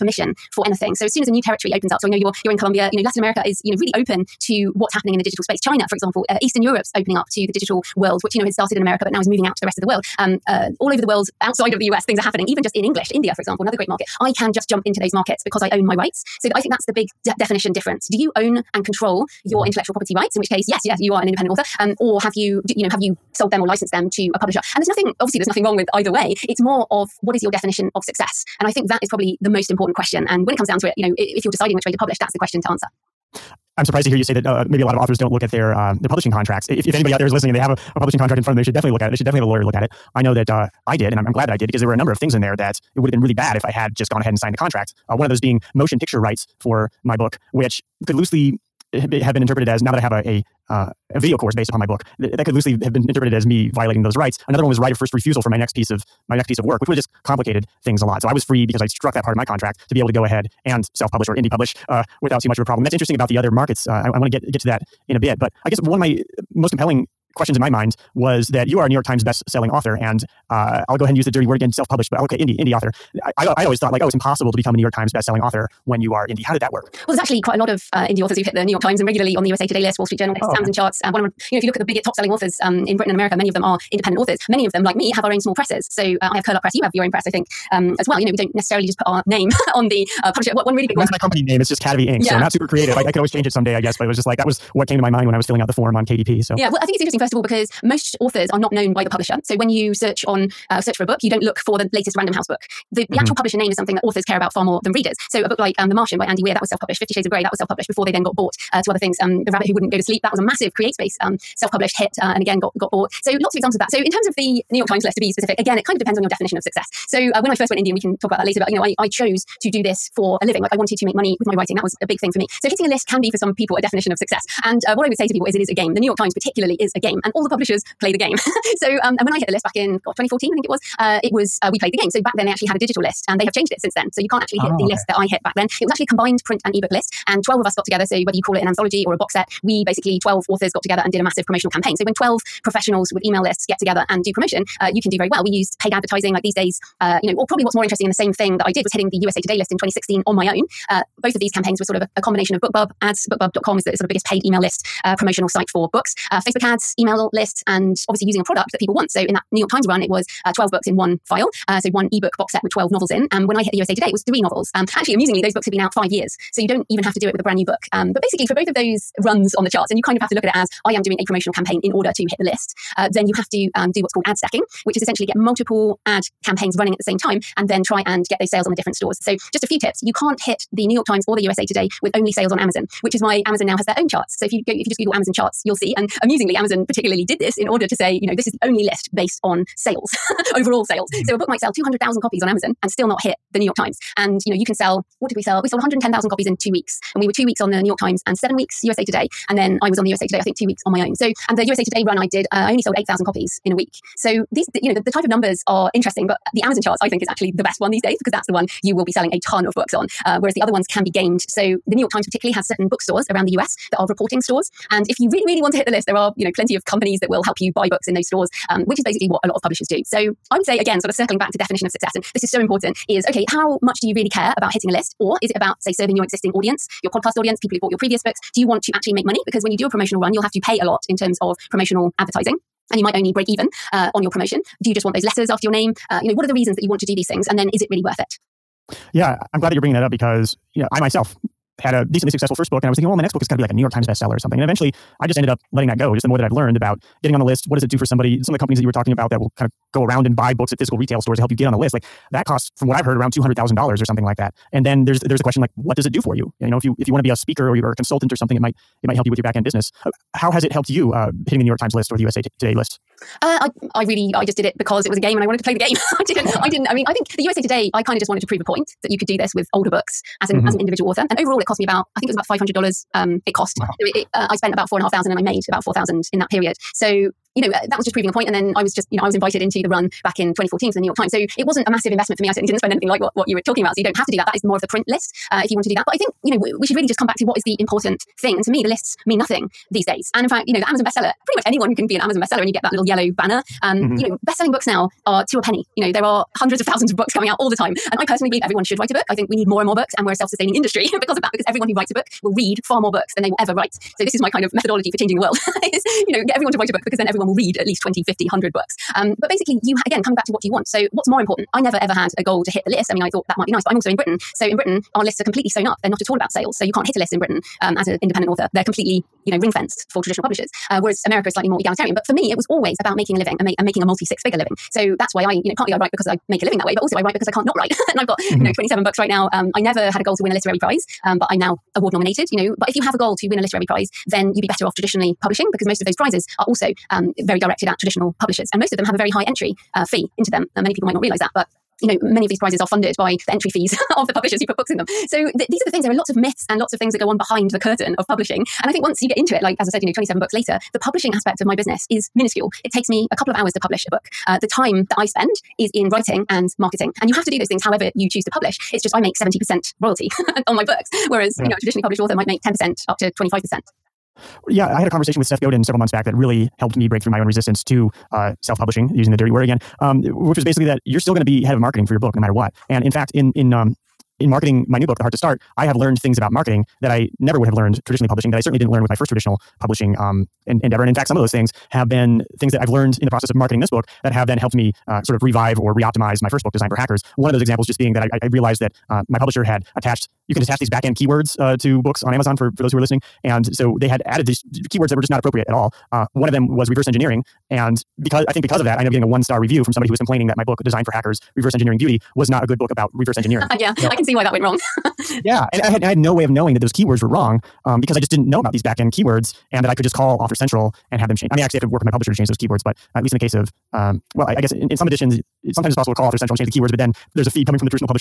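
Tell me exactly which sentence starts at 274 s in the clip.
So it, it, uh, I spent about four and a half thousand and I made about 4,000 in that period.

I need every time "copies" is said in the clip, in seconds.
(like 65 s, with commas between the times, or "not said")
192 s, 196 s, 203 s.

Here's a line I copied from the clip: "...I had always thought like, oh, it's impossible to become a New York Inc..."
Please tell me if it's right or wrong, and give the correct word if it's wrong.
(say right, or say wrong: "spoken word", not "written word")
wrong: "Times", not "Inc".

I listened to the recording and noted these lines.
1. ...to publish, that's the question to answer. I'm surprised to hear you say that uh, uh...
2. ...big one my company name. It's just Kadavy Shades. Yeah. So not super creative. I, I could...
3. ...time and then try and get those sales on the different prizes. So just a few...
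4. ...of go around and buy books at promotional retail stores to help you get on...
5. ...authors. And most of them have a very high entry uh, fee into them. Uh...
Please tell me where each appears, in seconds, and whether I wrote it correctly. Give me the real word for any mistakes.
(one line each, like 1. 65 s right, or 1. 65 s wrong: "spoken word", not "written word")
1. 31 s right
2. 90 s wrong: "Inc", not "Shades"
3. 177 s wrong: "stores", not "prizes"
4. 249 s wrong: "physical", not "promotional"
5. 338 s wrong: "publishers", not "authors".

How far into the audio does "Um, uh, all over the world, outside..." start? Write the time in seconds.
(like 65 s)
10 s.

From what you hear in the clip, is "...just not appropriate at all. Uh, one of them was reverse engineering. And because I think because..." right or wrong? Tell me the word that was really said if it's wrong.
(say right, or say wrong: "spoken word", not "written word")
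right.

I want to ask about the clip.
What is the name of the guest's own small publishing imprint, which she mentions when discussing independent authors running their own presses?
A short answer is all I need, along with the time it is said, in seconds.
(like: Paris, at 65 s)
Curl Up Press, at 86 s.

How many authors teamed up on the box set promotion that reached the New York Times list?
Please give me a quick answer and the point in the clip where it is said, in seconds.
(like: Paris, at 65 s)
12, at 137 s.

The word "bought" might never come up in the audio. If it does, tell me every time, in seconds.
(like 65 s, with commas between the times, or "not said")
108 s, 112 s, 227 s.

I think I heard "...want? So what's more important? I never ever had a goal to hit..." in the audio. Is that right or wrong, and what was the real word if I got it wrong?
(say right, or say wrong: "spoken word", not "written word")
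right.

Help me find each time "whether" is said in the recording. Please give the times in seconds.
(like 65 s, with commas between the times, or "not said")
138 s.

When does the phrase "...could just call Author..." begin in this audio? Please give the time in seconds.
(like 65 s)
409 s.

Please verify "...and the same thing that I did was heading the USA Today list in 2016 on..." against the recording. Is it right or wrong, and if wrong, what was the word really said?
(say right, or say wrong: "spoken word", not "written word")
right.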